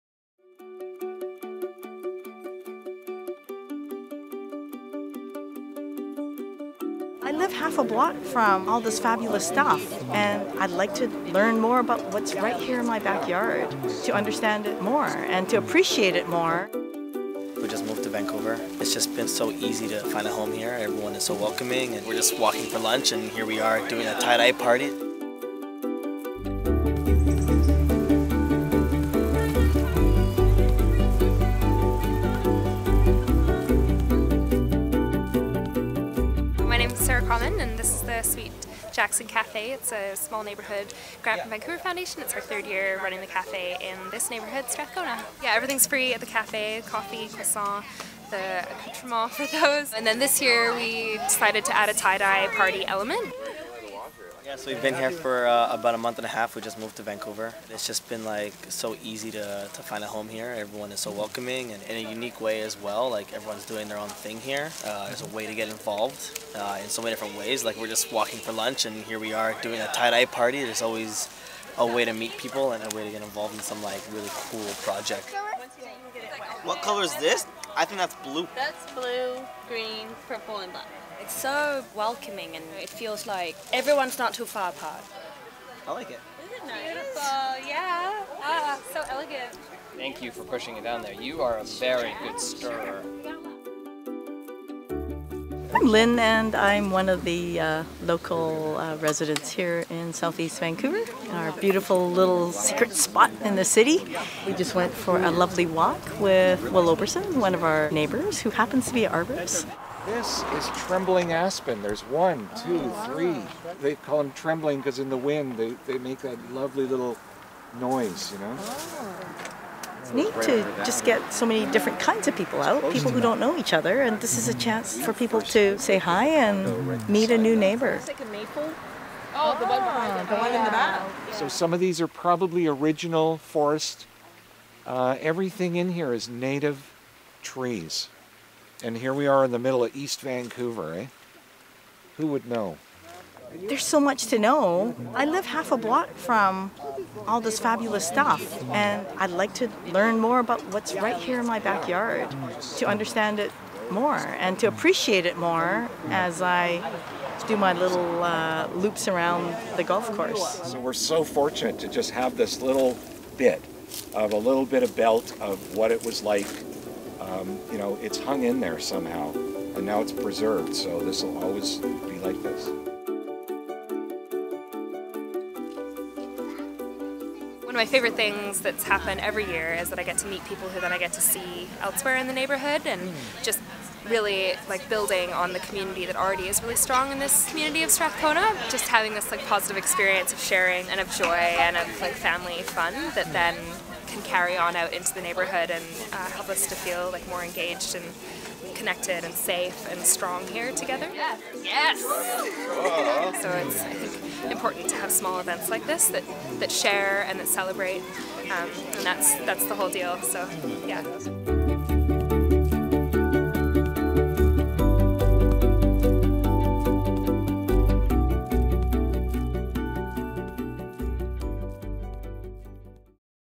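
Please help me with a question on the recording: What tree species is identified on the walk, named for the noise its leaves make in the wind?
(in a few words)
Trembling aspen.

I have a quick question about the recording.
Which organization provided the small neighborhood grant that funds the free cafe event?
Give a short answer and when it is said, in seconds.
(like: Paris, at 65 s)
Vancouver Foundation, at 41 s.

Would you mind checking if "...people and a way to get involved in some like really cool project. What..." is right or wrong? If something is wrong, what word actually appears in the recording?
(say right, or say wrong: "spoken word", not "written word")
right.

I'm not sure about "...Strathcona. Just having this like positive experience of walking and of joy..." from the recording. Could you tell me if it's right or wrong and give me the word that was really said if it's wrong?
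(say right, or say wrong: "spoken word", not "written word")
wrong: "sharing", not "walking".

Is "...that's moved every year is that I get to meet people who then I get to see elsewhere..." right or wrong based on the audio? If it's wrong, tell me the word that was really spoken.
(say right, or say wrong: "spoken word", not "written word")
wrong: "happened", not "moved".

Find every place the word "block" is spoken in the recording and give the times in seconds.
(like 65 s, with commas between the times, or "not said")
7 s, 145 s.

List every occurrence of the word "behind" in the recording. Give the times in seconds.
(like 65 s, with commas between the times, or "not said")
129 s.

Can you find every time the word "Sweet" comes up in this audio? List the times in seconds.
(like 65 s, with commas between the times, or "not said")
38 s.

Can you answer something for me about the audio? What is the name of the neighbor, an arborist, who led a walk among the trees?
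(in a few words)
Will Oberson.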